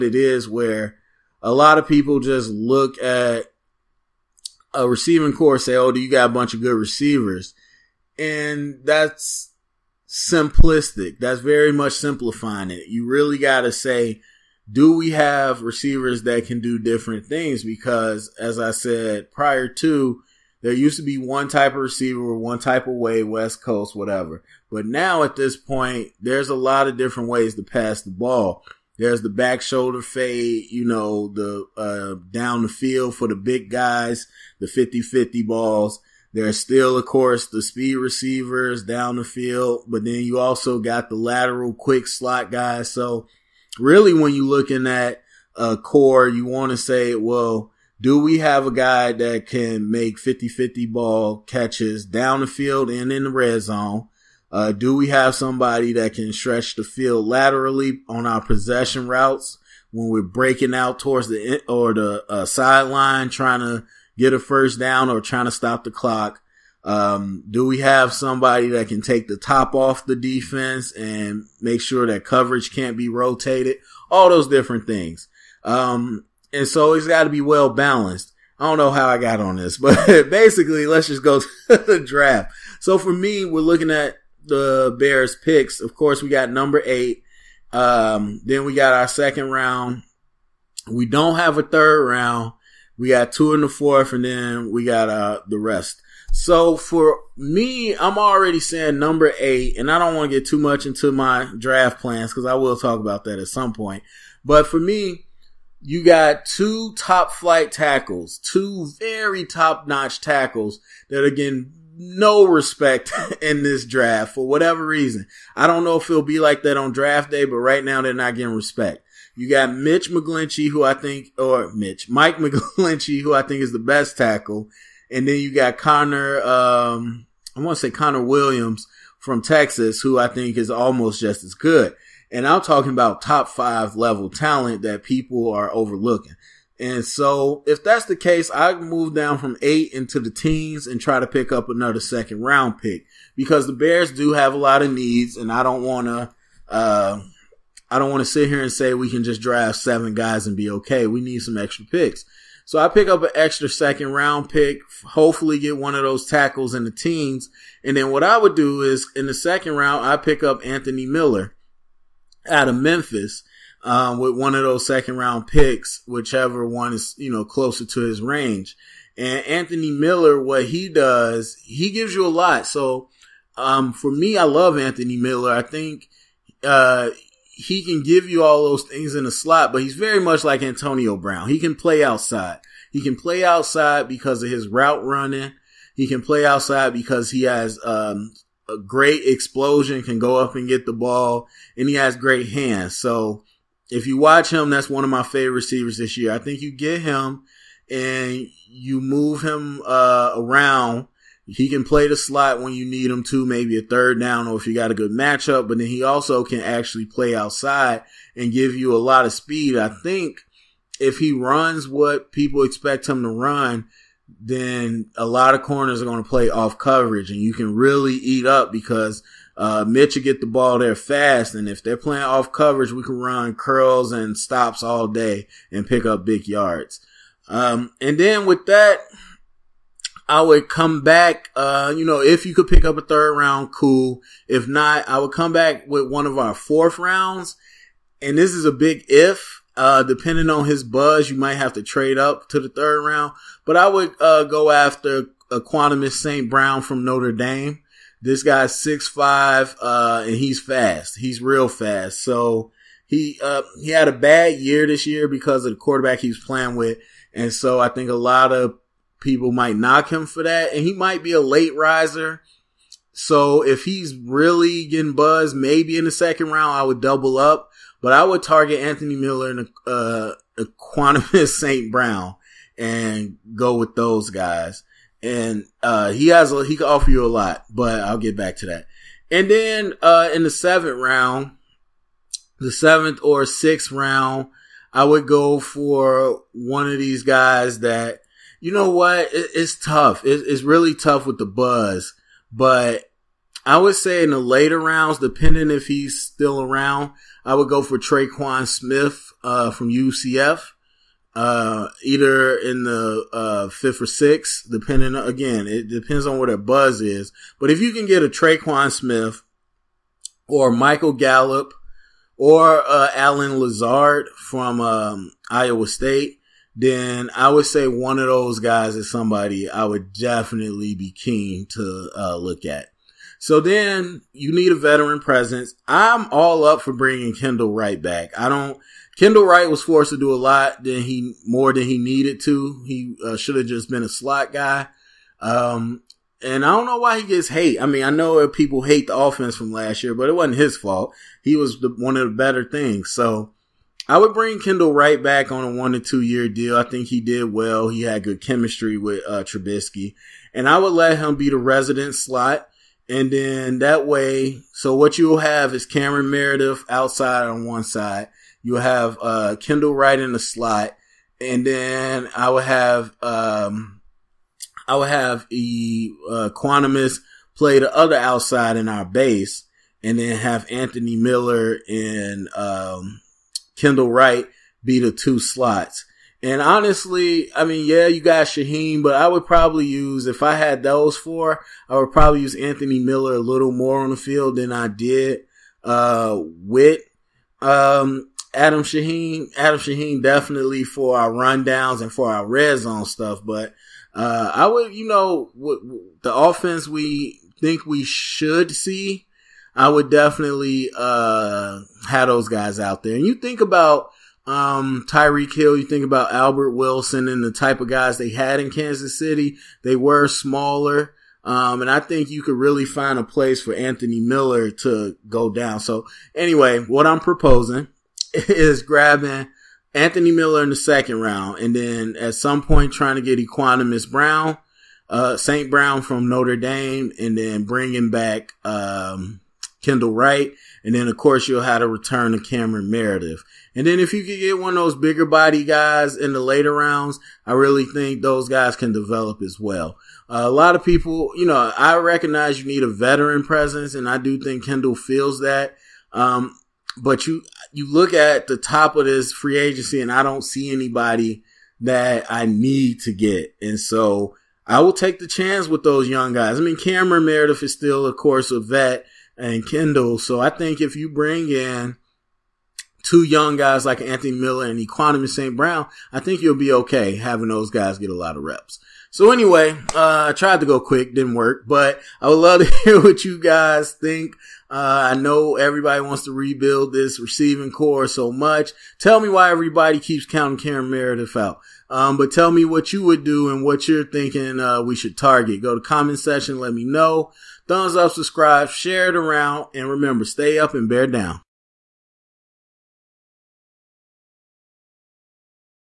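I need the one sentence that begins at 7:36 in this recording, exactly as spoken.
I mean, Cameron Meredith is still, of course, a vet and Kendall.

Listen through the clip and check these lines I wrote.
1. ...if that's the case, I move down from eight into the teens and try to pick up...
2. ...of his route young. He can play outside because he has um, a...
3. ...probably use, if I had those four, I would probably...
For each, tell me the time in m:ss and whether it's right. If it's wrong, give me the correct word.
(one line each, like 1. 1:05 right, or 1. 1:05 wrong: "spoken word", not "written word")
1. 2:17 right
2. 3:04 wrong: "running", not "young"
3. 6:19 right.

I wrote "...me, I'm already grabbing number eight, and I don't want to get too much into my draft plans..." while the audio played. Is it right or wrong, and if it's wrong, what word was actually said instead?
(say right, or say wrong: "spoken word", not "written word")
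wrong: "saying", not "grabbing".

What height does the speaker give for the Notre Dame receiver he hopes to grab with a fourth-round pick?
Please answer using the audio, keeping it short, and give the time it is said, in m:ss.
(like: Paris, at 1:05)
6'5", at 4:08.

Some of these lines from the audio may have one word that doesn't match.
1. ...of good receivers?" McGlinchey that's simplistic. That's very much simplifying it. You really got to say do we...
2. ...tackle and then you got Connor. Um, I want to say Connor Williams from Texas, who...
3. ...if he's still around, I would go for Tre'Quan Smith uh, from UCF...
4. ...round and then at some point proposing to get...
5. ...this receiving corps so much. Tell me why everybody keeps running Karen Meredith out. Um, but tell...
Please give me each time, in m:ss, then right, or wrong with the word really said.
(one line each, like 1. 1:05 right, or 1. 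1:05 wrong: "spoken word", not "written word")
1. 0:06 wrong: "And", not "McGlinchey"
2. 2:04 right
3. 4:55 right
4. 7:01 wrong: "trying", not "proposing"
5. 7:56 wrong: "counting", not "running".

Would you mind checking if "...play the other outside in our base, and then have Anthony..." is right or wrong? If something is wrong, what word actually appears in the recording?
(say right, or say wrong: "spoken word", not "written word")
right.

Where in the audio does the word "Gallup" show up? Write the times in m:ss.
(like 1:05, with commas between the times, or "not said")
5:11.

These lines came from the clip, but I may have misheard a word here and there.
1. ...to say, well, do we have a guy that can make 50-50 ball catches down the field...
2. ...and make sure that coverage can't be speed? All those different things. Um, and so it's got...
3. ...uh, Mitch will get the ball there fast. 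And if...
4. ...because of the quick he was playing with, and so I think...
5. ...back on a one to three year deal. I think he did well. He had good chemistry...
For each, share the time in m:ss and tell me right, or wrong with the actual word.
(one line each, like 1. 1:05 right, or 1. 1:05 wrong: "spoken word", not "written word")
1. 0:46 right
2. 1:10 wrong: "rotated", not "speed"
3. 3:39 right
4. 4:15 wrong: "quarterback", not "quick"
5. 5:45 wrong: "two", not "three".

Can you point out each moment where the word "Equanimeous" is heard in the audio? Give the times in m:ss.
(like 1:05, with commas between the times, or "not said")
4:05, 4:30, 7:03, 7:44.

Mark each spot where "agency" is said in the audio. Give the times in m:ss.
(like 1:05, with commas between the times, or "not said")
7:29.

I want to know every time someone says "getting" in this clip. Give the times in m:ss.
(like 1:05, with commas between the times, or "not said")
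1:51, 1:58, 4:24.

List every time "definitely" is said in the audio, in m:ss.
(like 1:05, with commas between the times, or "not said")
5:20, 6:30, 6:40.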